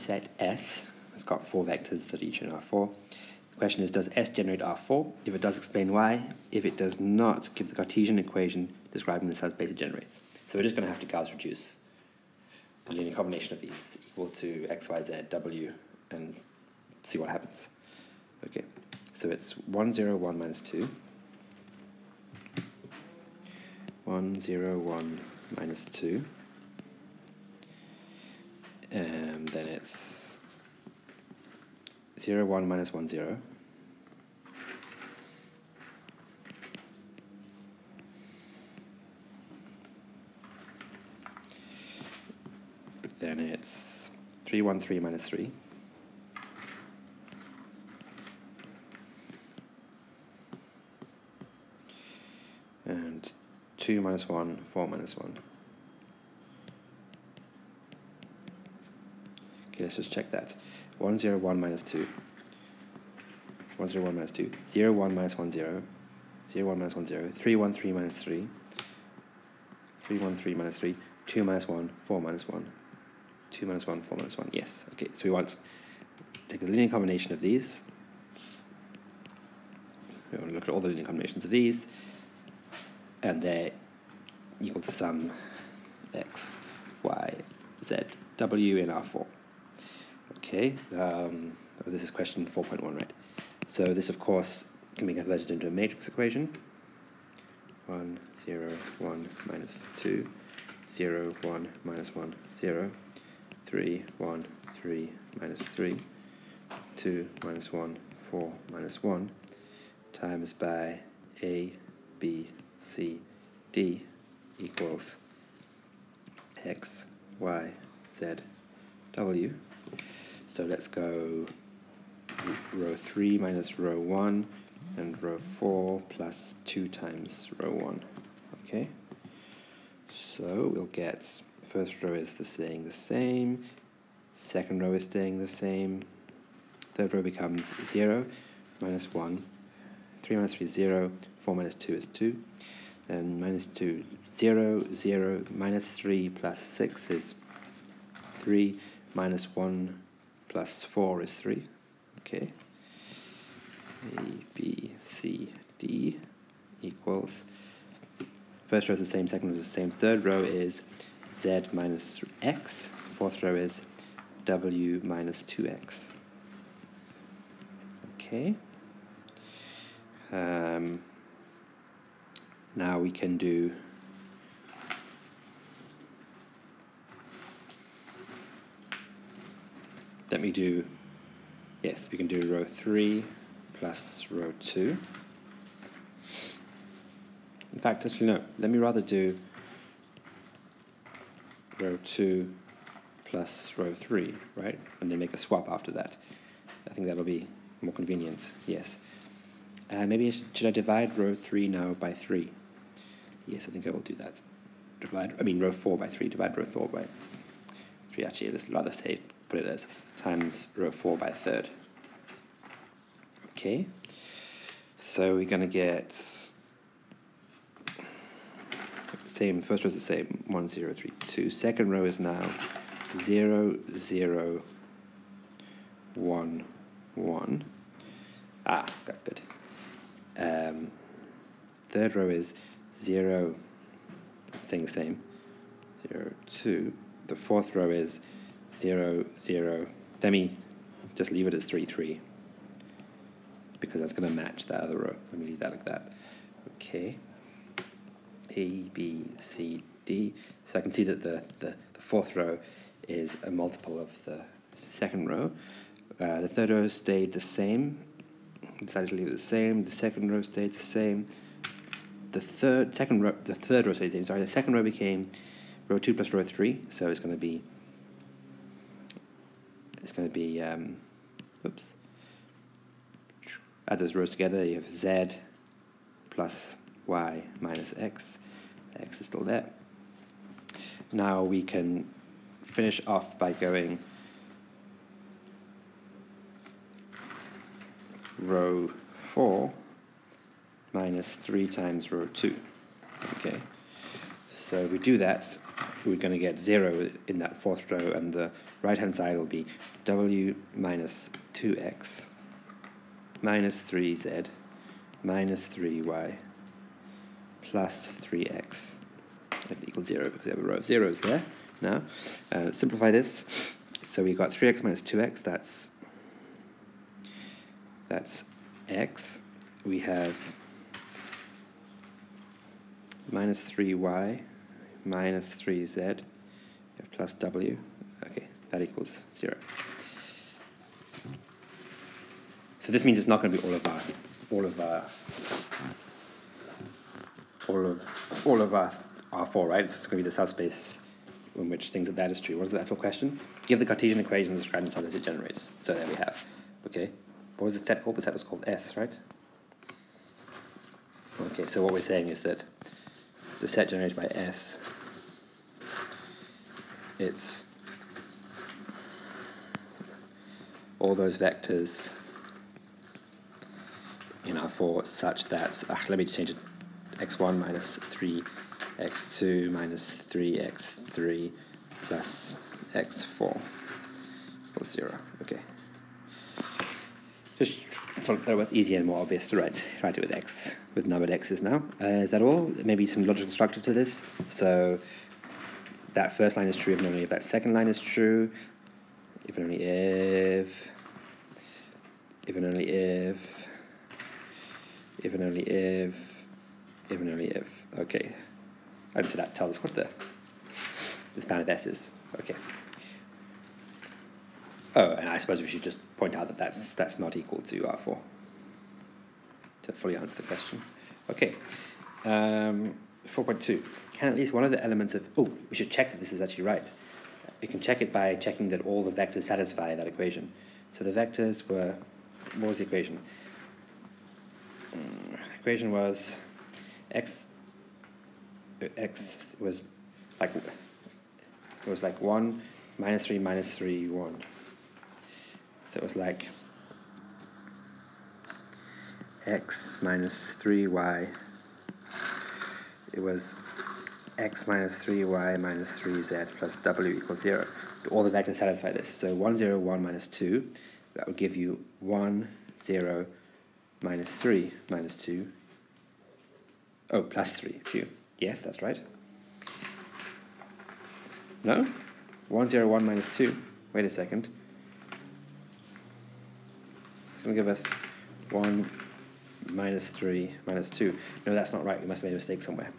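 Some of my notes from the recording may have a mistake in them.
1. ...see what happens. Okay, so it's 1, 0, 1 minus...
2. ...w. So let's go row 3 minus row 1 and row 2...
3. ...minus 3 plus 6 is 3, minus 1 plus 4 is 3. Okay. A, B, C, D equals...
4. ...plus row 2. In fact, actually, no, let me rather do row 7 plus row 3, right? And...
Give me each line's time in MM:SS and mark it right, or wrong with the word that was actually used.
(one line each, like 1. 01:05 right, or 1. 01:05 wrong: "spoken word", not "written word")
1. 00:17 right
2. 01:59 wrong: "4", not "2"
3. 02:25 right
4. 03:03 wrong: "2", not "7".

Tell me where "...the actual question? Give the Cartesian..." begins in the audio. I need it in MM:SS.
05:42.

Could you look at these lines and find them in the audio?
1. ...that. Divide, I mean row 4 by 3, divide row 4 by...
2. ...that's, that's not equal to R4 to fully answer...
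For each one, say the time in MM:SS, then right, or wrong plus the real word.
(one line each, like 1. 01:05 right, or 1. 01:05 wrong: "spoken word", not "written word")
1. 03:24 right
2. 06:46 right.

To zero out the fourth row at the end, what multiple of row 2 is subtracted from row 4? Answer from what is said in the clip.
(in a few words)
3.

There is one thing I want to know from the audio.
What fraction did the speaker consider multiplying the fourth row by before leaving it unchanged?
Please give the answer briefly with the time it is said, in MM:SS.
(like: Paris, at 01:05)
a third, at 03:31.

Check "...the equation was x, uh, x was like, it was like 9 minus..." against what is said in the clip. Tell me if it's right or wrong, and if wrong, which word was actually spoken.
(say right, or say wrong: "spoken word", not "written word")
wrong: "1", not "9".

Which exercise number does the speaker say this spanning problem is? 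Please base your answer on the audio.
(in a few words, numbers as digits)
4.1.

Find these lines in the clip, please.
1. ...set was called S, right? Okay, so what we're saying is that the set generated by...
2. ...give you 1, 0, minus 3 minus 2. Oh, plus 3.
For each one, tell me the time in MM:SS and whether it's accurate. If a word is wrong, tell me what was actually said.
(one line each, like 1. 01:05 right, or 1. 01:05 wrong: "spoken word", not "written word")
1. 05:48 right
2. 07:31 right.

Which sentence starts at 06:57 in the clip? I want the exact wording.
We can check it by checking that all the vectors satisfy that equation.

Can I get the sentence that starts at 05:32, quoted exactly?
So this means it's not going to be all of our, all of our, all of, all of our R4, right?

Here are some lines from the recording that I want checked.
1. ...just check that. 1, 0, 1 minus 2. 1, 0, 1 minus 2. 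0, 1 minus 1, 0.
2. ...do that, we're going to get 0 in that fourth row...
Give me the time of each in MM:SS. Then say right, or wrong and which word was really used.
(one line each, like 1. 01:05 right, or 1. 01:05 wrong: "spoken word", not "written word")
1. 00:59 right
2. 04:54 right.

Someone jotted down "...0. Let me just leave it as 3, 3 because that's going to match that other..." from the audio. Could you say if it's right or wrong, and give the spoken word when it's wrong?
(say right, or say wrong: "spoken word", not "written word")
right.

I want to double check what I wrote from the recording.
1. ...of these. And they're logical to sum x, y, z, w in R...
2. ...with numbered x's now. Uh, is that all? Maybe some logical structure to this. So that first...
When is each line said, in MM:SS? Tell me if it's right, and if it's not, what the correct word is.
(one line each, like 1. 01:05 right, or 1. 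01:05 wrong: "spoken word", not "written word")
1. 01:21 wrong: "equal", not "logical"
2. 06:20 right.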